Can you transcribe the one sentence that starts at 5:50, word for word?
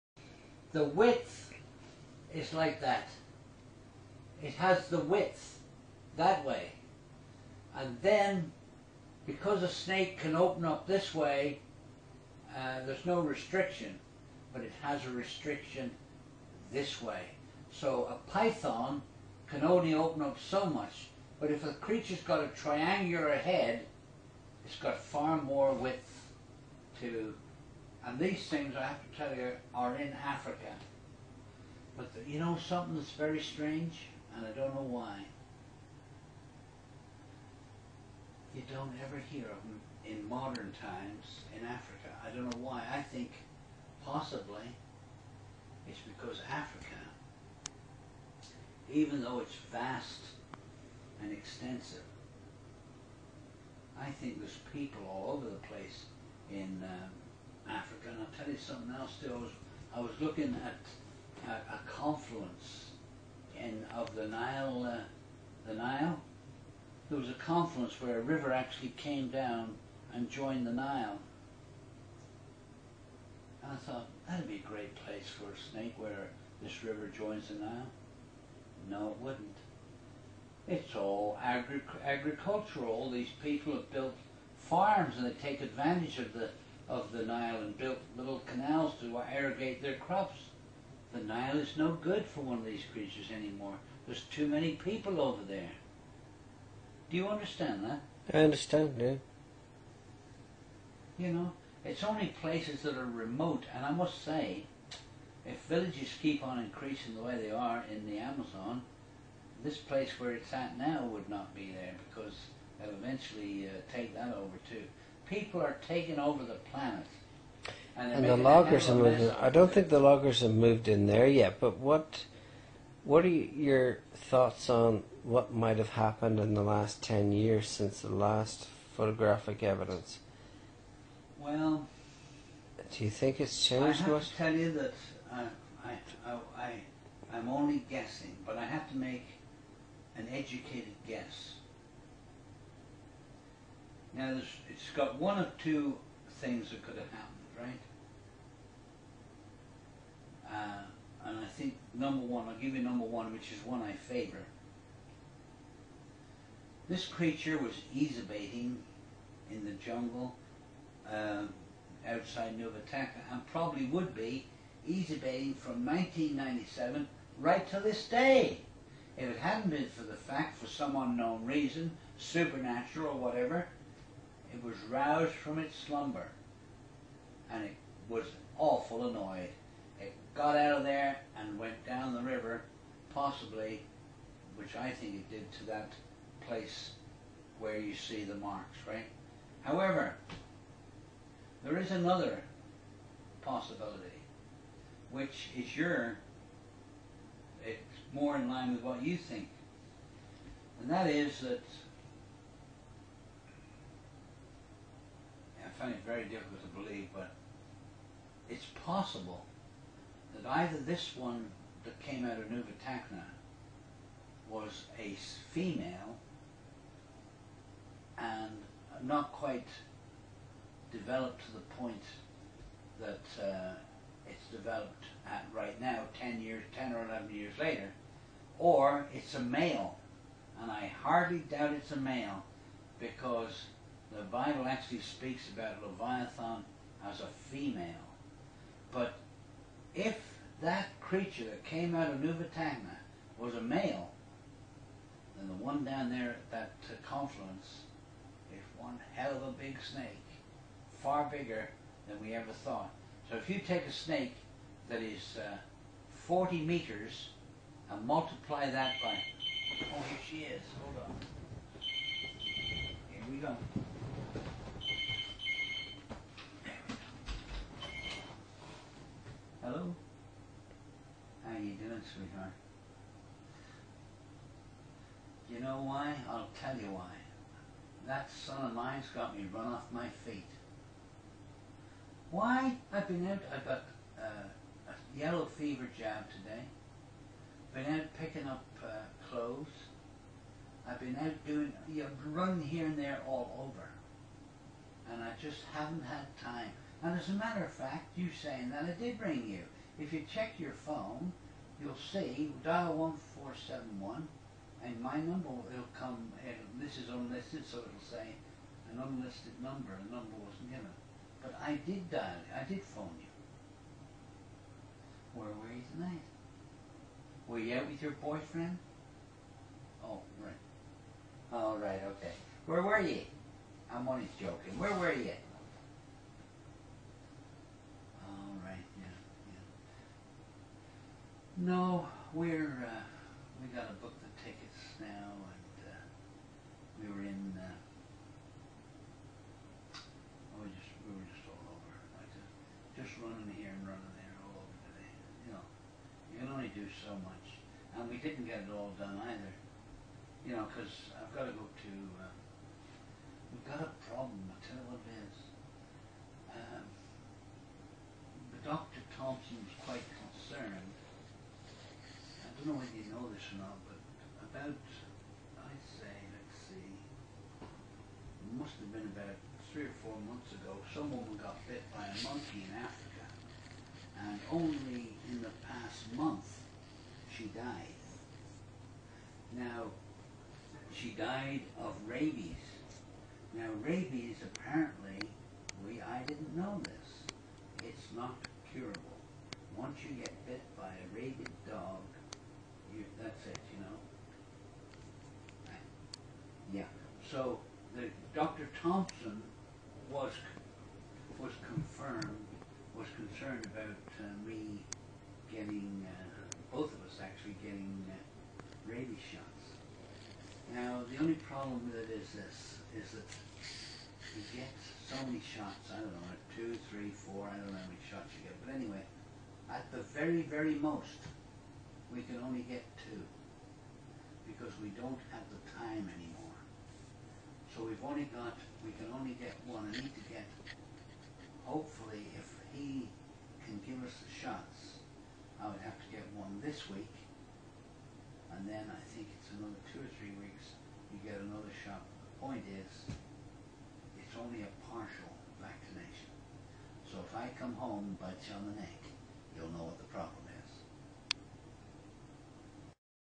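You know, because I've got to go to.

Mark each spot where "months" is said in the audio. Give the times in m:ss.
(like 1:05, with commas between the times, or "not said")
6:10, 6:16.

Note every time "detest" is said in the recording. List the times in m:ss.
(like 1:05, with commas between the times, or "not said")
not said.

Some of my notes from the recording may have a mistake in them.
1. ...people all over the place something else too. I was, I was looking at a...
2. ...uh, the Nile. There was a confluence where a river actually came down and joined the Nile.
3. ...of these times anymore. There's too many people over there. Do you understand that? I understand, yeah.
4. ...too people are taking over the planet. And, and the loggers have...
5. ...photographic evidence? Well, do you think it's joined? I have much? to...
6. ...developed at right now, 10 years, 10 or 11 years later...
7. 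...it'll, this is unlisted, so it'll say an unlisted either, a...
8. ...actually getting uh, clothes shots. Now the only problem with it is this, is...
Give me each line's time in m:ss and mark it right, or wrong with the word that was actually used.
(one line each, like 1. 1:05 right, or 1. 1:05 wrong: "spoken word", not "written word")
1. 0:54 right
2. 1:04 right
3. 1:32 wrong: "creatures", not "times"
4. 1:54 right
5. 2:08 wrong: "changed", not "joined"
6. 3:44 right
7. 5:06 wrong: "number", not "either"
8. 6:47 wrong: "rabies", not "clothes".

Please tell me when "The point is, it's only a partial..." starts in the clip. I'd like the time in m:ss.
7:22.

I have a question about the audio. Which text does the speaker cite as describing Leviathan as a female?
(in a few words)
the Bible.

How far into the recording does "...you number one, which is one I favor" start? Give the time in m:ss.
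2:32.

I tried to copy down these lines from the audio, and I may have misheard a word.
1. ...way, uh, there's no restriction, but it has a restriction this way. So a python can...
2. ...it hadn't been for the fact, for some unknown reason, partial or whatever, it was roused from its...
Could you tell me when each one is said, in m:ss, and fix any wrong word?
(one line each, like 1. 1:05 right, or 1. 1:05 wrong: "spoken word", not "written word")
1. 0:11 right
2. 2:49 wrong: "supernatural", not "partial".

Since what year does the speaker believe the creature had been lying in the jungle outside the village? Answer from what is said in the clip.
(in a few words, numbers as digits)
1997.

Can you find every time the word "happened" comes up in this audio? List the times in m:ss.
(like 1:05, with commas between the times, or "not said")
2:05, 2:27.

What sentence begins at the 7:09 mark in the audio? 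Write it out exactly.
I need to get, hopefully, if he can give us the shots, I would have to get one this week.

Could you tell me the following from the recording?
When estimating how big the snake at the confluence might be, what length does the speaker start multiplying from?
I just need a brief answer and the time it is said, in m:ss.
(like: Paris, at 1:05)
40 meters, at 4:16.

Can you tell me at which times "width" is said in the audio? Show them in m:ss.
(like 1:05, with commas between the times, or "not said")
0:00, 0:04, 0:25.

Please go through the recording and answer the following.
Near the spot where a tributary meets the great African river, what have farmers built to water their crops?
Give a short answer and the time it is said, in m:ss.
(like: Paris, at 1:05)
little canals, at 1:28.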